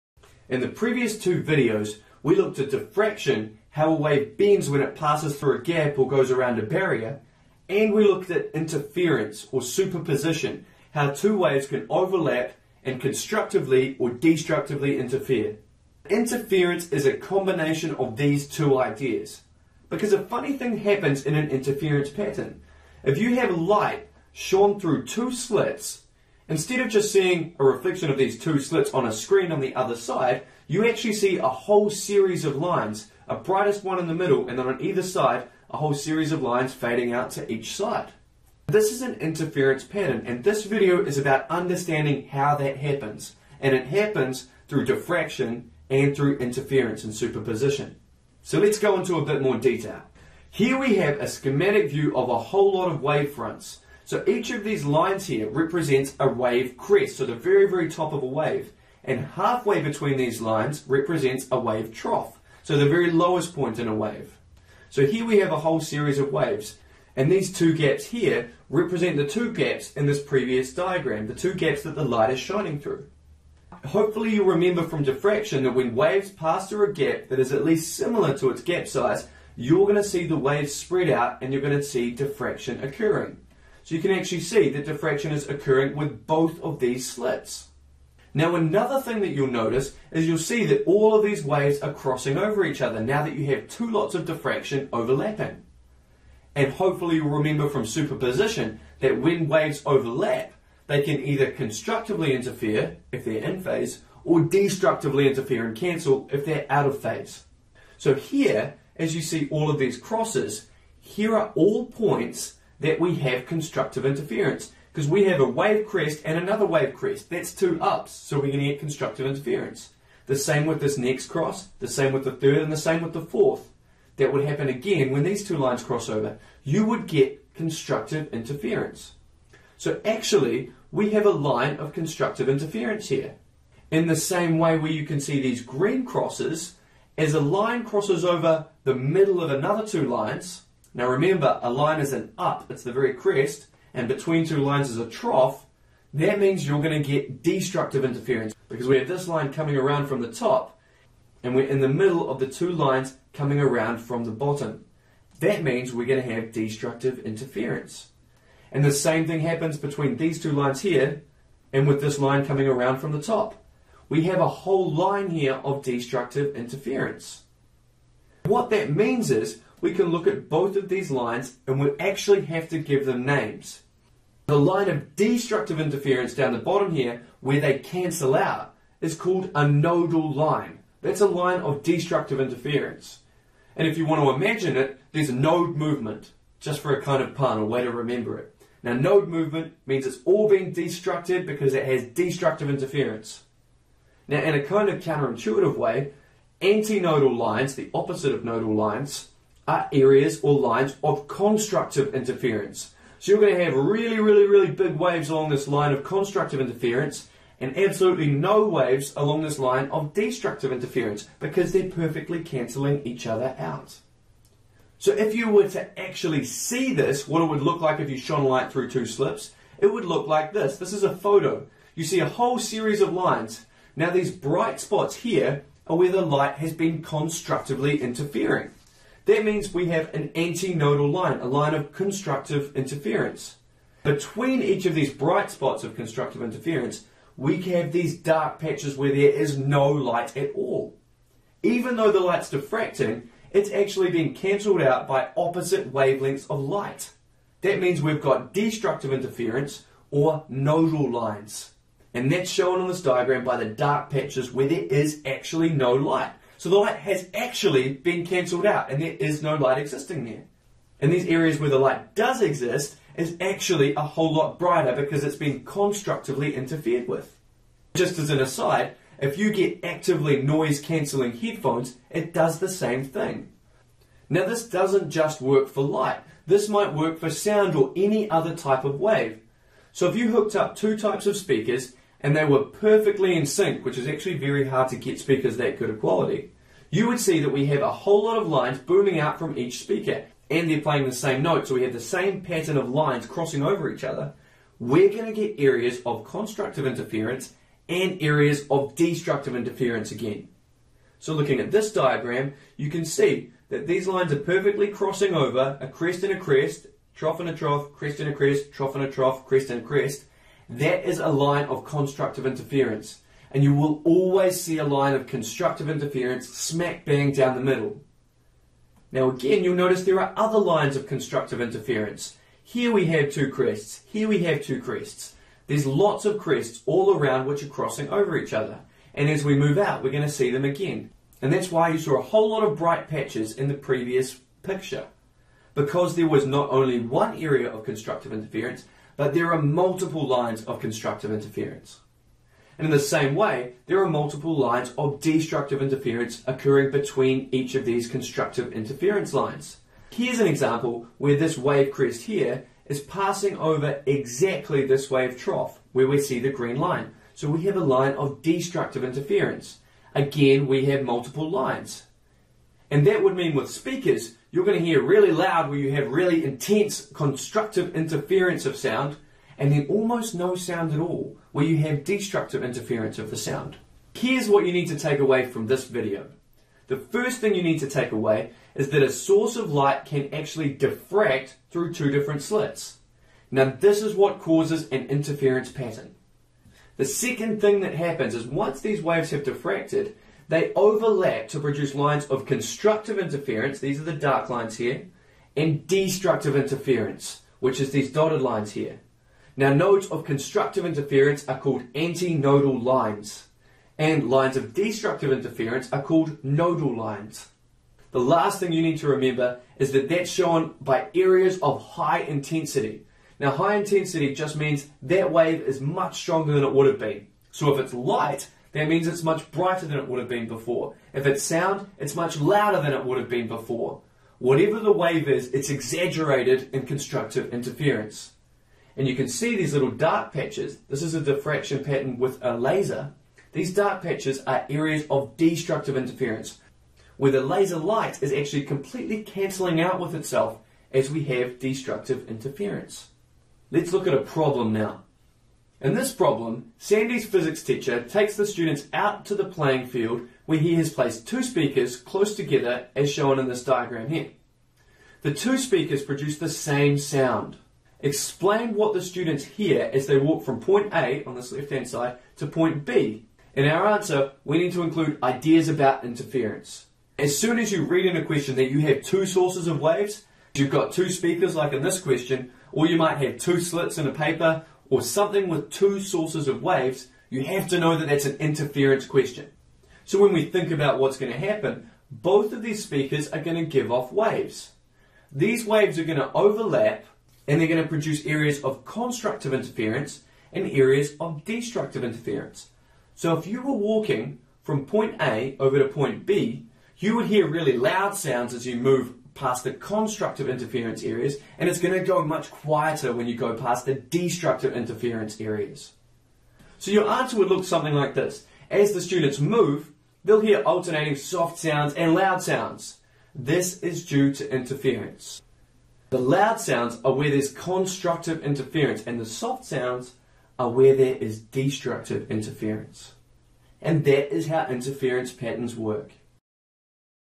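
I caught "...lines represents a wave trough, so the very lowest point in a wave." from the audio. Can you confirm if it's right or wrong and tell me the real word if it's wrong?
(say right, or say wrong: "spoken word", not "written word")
right.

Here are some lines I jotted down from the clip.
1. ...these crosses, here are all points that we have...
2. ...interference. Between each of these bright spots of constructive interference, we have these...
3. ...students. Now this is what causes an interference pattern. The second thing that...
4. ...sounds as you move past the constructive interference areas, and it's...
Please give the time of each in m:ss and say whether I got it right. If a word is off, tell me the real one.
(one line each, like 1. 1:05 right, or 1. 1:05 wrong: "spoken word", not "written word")
1. 1:49 right
2. 3:52 right
3. 6:22 wrong: "slits", not "students"
4. 8:18 right.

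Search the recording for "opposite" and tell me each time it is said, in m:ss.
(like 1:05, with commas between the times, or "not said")
3:17, 4:05.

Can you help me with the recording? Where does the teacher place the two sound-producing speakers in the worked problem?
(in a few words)
Playing field.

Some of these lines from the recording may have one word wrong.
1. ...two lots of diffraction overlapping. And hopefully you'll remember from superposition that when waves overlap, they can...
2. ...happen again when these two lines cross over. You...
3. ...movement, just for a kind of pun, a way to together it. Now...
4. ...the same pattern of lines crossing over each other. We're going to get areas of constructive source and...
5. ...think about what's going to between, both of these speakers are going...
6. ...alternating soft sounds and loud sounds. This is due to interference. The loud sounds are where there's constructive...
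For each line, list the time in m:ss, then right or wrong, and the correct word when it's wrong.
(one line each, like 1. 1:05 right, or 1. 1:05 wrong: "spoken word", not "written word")
1. 1:33 right
2. 2:04 right
3. 3:05 wrong: "remember", not "together"
4. 4:51 wrong: "interference", not "source"
5. 8:00 wrong: "happen", not "between"
6. 8:30 right.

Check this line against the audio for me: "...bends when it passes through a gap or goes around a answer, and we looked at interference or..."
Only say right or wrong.
wrong.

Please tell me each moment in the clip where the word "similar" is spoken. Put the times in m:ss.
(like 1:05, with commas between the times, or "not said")
1:17.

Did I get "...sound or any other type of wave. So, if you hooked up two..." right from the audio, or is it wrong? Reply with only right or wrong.
right.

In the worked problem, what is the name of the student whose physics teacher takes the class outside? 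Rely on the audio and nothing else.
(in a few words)
Sandy.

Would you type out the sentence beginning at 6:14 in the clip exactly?
Here's what you need to take away from this video.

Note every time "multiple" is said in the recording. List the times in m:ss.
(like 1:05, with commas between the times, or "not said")
5:39, 5:44, 6:01.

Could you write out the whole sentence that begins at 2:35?
That means we're going to have destructive interference.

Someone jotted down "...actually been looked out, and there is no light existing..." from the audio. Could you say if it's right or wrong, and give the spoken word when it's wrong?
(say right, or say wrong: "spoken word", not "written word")
wrong: "cancelled", not "looked".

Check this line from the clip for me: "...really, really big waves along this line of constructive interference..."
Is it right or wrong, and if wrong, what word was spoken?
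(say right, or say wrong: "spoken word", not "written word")
right.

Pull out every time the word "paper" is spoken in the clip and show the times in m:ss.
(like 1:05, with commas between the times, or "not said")
7:54.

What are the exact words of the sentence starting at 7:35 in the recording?
The two speakers produce the same sound.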